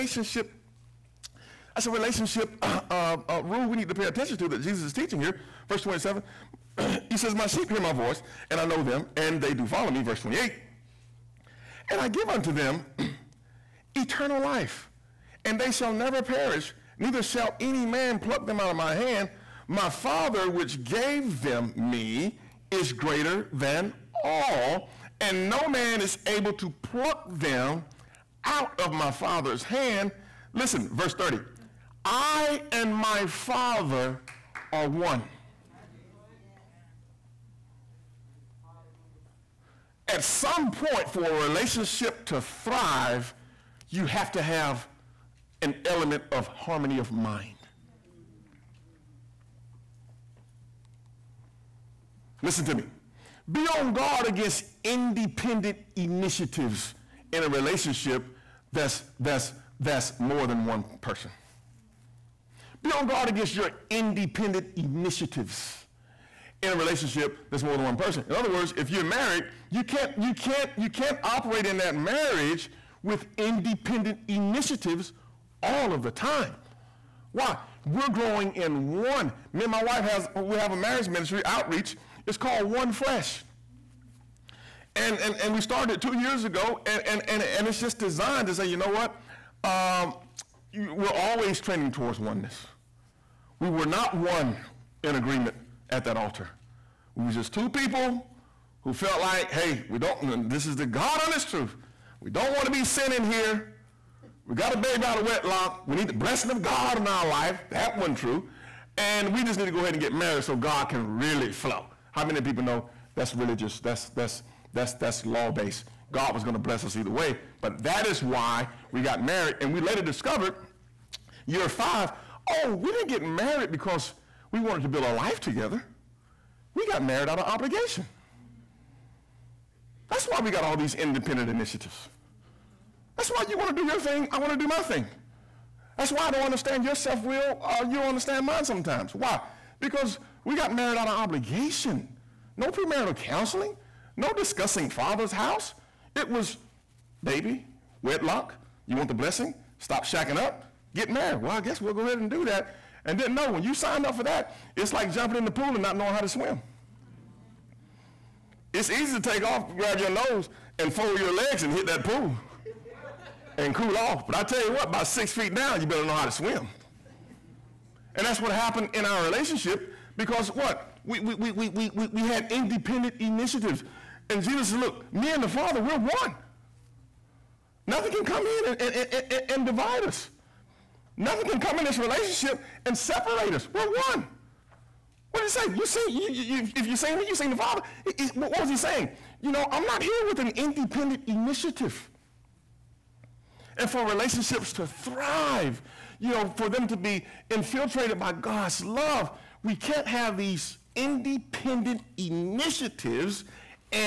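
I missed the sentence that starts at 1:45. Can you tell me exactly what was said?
We need the blessing of God in our life.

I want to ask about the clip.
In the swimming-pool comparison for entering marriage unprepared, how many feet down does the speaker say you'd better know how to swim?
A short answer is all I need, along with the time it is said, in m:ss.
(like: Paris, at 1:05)
6 feet, at 2:45.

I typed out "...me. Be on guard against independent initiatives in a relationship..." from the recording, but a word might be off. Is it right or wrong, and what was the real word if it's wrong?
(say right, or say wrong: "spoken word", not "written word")
right.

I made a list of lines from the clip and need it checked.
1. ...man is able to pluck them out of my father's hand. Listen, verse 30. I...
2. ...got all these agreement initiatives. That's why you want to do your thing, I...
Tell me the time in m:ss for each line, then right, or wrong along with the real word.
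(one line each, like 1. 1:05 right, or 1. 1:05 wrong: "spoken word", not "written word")
1. 0:25 right
2. 2:10 wrong: "independent", not "agreement".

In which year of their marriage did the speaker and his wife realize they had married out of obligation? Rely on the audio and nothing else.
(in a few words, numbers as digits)
Year 5.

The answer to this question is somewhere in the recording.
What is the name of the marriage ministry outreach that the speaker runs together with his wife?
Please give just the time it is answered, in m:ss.
1:22.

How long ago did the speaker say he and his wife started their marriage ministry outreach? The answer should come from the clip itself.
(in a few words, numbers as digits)
2 years ago.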